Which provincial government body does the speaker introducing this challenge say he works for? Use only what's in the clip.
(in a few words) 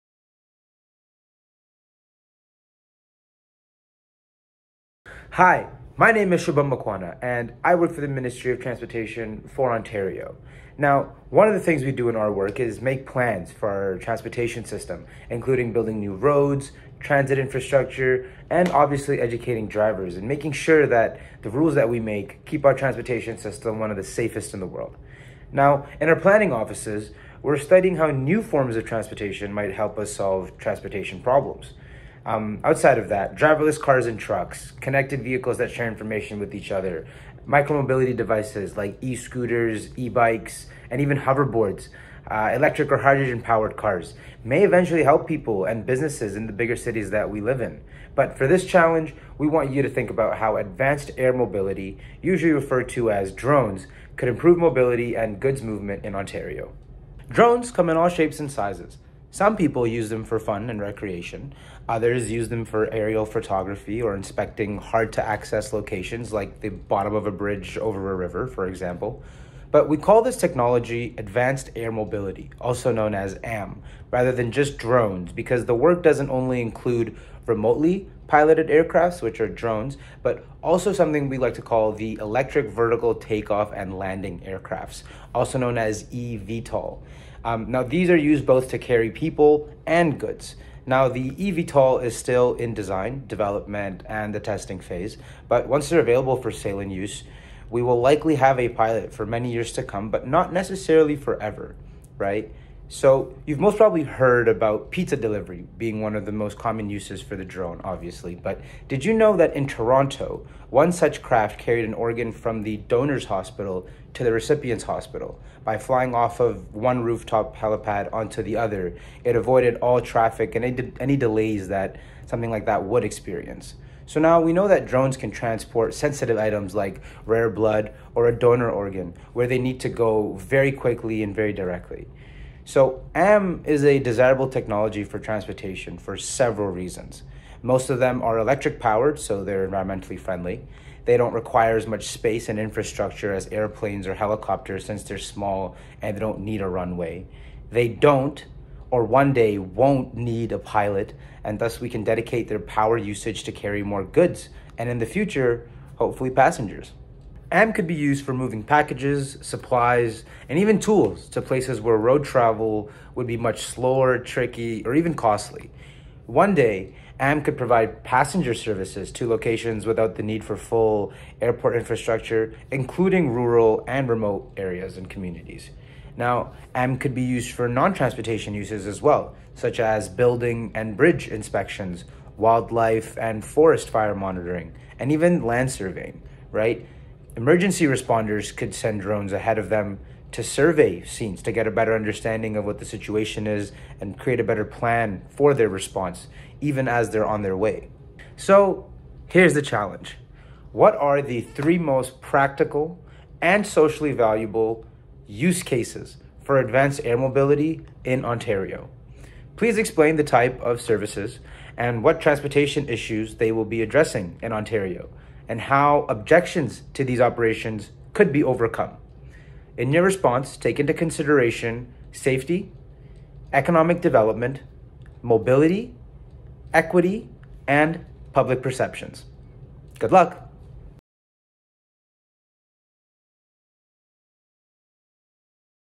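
Ministry of Transportation for Ontario.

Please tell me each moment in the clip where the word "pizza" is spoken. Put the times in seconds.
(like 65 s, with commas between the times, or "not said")
104 s.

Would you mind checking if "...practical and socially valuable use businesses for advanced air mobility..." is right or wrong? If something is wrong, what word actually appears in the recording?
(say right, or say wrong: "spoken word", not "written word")
wrong: "cases", not "businesses".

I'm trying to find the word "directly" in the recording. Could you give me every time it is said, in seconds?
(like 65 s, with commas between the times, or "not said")
131 s.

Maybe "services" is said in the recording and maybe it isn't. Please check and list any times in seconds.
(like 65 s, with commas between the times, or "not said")
168 s, 210 s.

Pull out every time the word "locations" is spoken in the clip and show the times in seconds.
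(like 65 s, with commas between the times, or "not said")
65 s, 169 s.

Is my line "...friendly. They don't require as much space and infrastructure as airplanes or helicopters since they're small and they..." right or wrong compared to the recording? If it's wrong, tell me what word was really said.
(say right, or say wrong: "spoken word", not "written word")
right.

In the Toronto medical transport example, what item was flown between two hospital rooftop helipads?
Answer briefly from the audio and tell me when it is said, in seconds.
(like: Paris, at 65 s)
An organ, at 111 s.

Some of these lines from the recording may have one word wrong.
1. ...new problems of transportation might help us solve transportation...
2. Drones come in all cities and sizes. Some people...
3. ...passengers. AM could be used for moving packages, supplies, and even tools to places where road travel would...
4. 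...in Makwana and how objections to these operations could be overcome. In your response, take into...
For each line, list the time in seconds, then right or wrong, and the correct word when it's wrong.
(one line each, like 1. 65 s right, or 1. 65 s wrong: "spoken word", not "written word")
1. 28 s wrong: "forms", not "problems"
2. 57 s wrong: "shapes", not "cities"
3. 156 s right
4. 214 s wrong: "Ontario", not "Makwana".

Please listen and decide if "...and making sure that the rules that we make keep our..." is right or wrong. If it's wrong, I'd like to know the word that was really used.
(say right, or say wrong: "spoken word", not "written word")
right.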